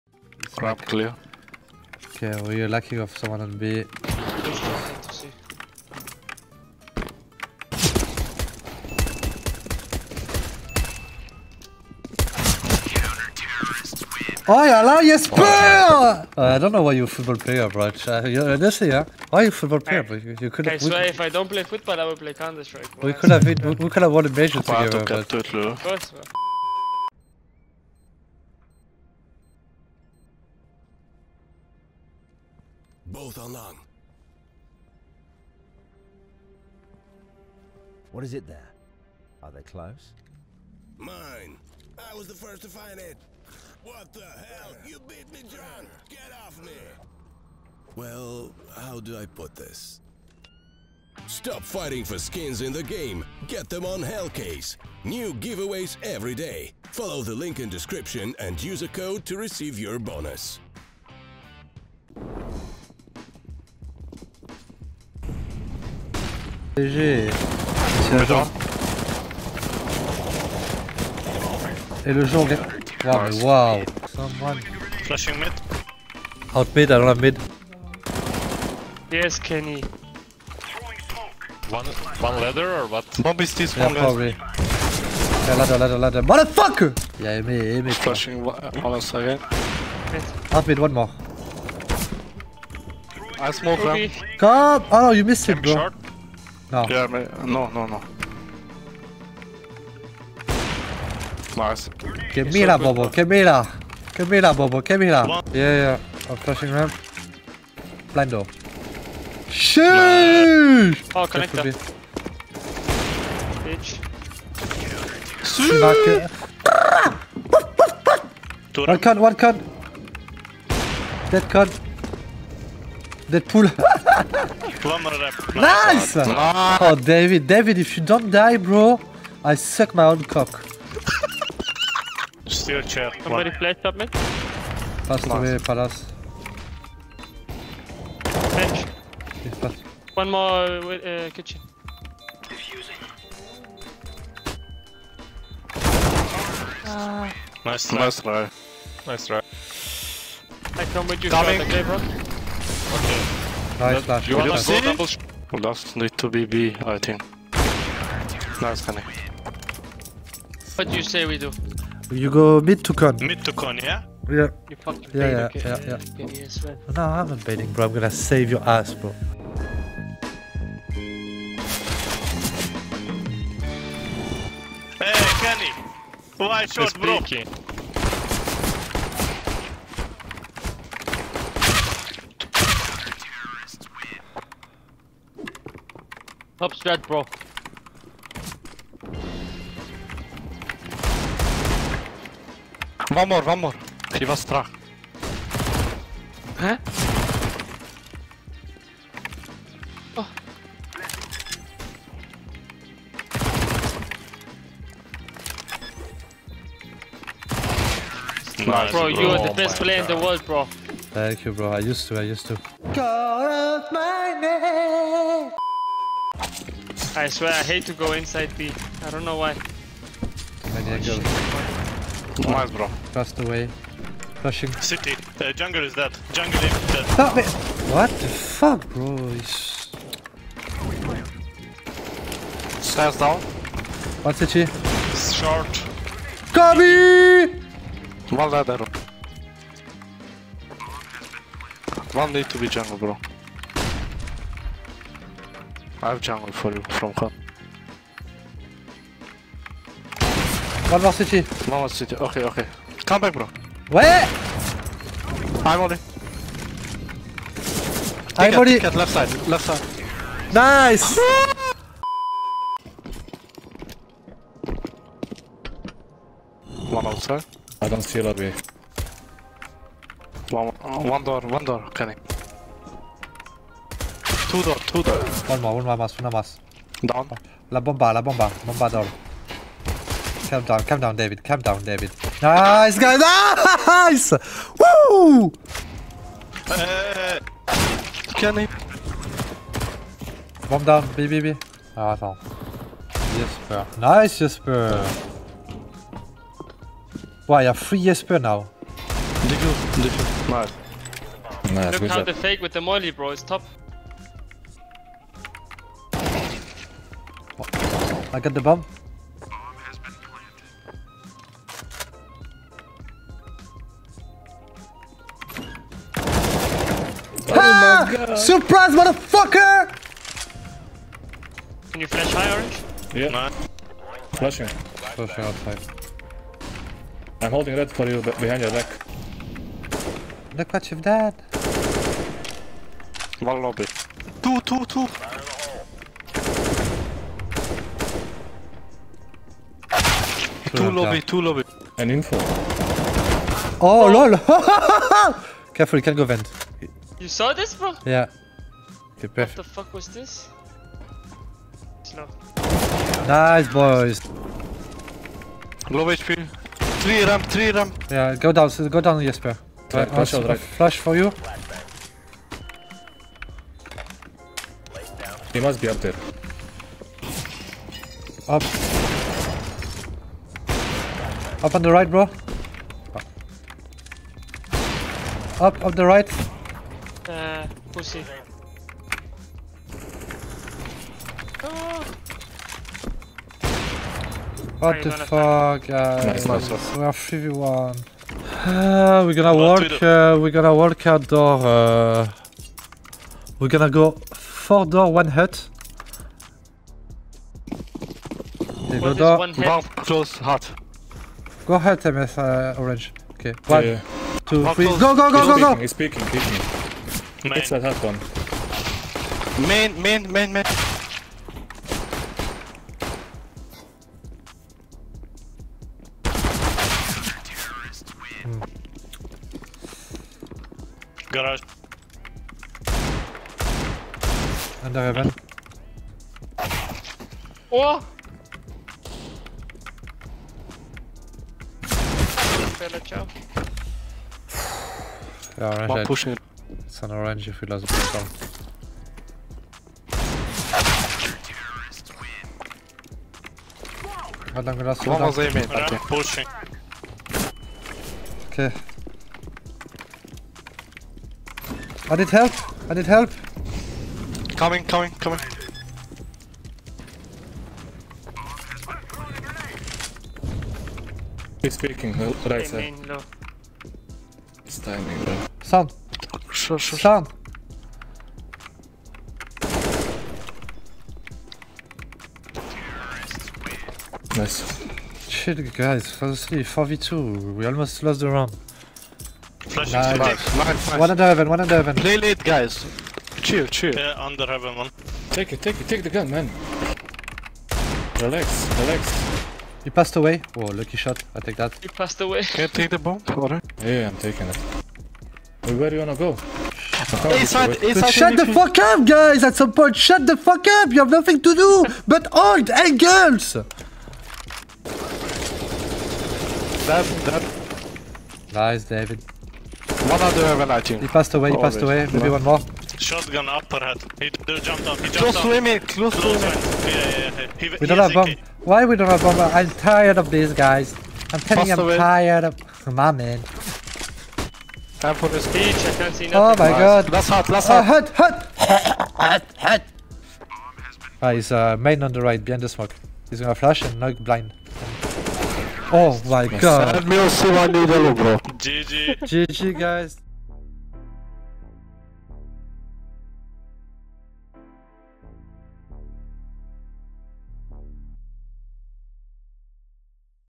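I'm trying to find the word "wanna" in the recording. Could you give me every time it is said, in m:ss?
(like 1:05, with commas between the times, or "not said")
2:34, 8:16.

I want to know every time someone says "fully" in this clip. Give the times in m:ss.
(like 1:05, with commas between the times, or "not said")
not said.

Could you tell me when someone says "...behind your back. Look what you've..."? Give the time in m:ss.
5:28.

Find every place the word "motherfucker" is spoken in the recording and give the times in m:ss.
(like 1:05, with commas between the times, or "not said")
1:26, 5:18.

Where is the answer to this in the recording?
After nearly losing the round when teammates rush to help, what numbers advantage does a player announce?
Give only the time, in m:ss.
7:56.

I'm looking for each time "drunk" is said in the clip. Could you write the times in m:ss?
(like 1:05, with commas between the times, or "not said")
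0:45.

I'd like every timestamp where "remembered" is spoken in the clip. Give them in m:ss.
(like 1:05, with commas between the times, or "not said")
not said.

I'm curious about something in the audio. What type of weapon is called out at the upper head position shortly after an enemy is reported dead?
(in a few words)
Shotgun.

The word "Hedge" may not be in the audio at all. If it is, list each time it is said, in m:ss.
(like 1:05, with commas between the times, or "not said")
2:18.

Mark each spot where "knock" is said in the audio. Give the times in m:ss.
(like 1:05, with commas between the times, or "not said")
8:53.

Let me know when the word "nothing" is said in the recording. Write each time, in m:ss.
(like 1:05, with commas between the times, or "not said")
8:21, 8:46.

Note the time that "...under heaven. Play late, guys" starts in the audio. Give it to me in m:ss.
8:01.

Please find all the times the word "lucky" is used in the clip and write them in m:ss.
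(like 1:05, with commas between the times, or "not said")
0:02, 8:10.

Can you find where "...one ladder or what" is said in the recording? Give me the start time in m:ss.
1:22.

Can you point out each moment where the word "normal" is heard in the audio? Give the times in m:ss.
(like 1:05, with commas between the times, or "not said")
not said.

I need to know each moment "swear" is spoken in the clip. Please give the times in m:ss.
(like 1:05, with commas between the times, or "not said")
0:20, 3:37.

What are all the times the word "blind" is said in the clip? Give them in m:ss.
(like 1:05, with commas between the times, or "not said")
1:48, 8:54.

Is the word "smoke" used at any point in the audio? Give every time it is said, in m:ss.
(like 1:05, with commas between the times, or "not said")
1:33, 8:52.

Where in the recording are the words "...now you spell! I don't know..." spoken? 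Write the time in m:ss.
0:14.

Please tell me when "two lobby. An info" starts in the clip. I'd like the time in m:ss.
5:41.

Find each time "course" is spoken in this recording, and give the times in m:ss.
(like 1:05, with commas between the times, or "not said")
0:25.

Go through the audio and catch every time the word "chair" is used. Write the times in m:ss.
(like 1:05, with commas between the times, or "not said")
2:12.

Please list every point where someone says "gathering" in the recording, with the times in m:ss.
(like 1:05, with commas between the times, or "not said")
not said.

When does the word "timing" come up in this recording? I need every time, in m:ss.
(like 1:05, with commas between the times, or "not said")
7:44.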